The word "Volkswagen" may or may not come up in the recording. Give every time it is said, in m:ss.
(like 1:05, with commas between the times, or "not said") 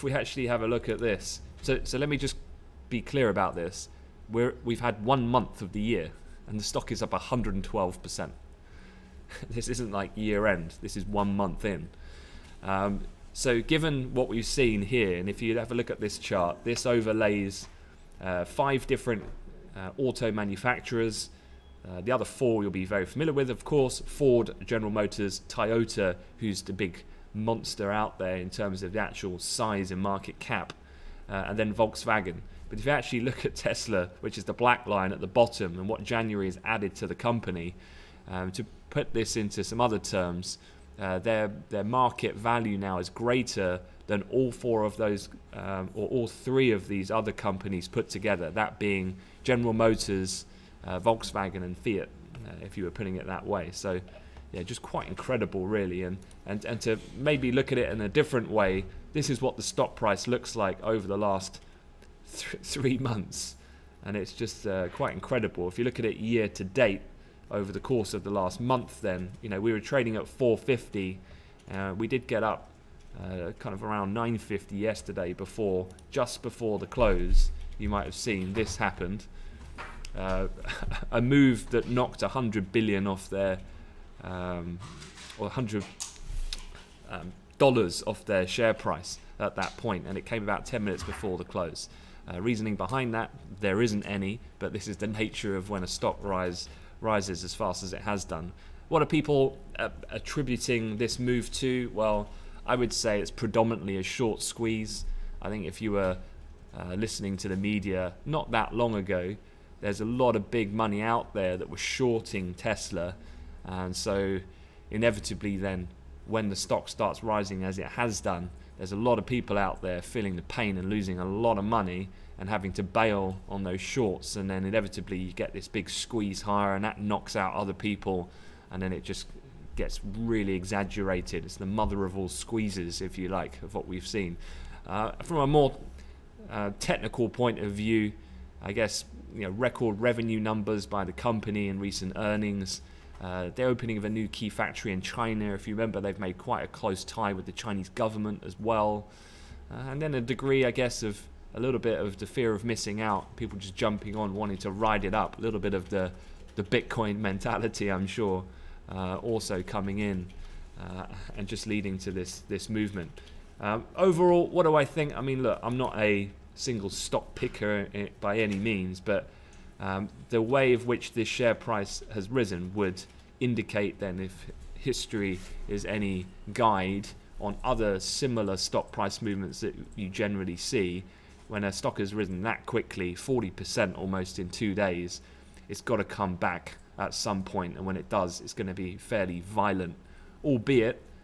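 0:31, 0:51.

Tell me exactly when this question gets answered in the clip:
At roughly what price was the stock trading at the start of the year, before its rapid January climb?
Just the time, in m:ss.
1:10.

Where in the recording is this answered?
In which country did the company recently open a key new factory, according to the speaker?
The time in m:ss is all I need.
2:24.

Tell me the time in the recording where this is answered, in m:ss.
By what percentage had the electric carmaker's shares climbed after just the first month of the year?
0:07.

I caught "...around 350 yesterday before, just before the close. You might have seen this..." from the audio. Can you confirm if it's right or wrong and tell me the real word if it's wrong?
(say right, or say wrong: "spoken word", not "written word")
wrong: "950", not "350".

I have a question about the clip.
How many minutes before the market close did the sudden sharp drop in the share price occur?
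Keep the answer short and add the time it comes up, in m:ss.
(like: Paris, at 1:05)
10, at 1:30.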